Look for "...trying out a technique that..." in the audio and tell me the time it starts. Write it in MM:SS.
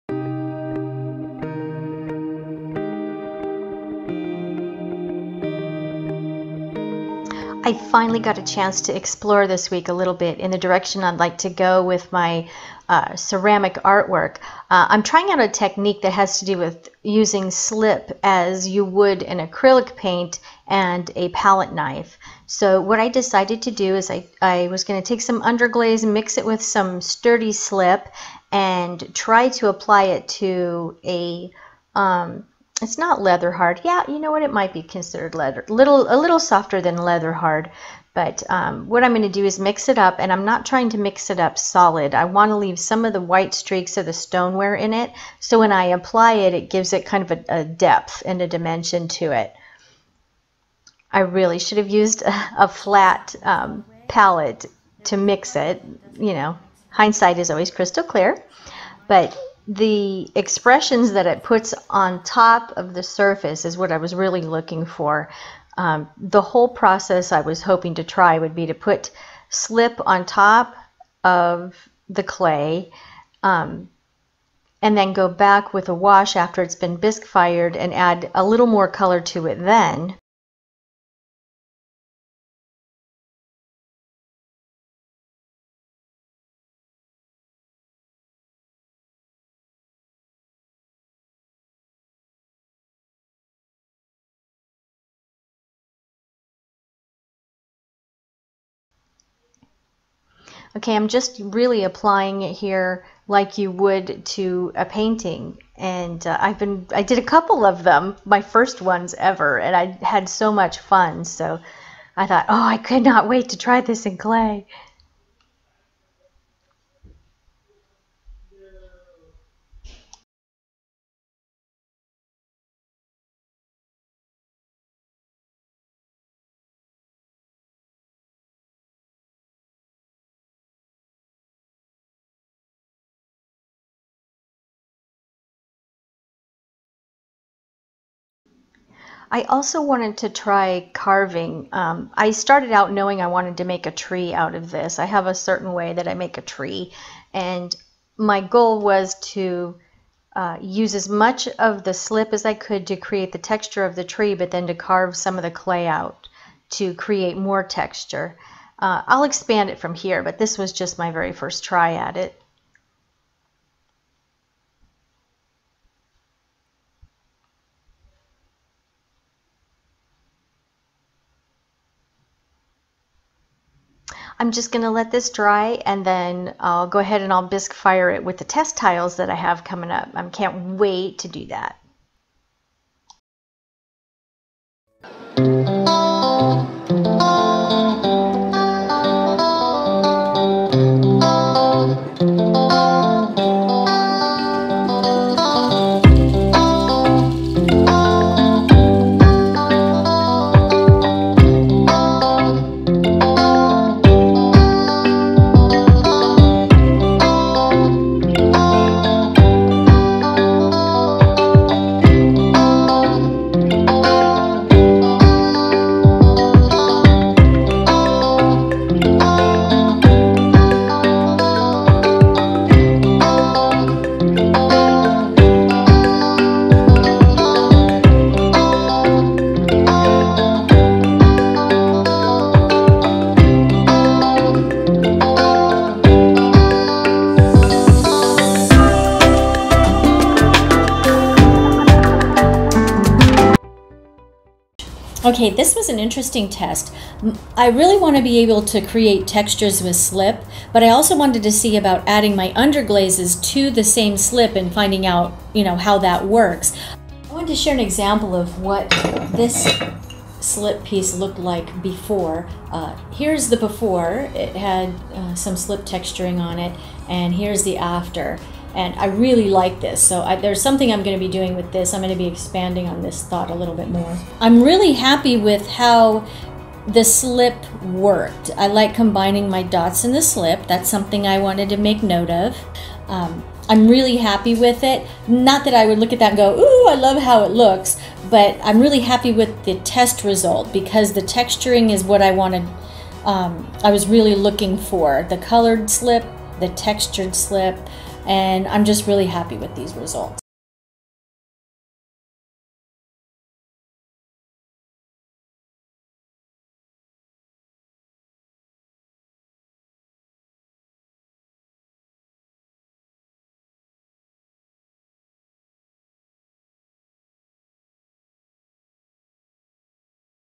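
00:15.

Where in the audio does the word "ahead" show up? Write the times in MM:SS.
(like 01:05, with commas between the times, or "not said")
02:56.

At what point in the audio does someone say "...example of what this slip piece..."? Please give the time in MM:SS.
04:17.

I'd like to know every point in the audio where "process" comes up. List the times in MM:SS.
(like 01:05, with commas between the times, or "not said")
01:06.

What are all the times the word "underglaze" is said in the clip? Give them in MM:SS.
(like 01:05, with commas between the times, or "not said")
00:25, 04:12.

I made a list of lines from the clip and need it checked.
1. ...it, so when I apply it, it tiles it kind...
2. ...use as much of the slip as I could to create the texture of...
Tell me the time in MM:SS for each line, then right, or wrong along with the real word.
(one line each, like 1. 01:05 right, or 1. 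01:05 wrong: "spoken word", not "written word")
1. 00:44 wrong: "gives", not "tiles"
2. 02:30 right.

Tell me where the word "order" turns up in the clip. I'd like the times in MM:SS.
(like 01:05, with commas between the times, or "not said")
not said.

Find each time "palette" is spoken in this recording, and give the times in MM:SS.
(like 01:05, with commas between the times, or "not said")
00:21, 00:54.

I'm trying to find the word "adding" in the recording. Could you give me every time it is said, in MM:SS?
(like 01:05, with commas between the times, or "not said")
04:12.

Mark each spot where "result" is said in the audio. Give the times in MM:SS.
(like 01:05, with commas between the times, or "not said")
04:50, 04:59.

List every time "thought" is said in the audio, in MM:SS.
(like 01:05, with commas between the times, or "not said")
01:52, 04:33.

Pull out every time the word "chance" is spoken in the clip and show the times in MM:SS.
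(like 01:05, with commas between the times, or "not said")
00:08.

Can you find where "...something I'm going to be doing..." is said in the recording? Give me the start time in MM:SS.
04:30.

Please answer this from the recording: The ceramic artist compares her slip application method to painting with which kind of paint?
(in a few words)
acrylic paint.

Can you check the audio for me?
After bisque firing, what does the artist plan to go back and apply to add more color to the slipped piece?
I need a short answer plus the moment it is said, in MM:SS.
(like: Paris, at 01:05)
a wash, at 01:15.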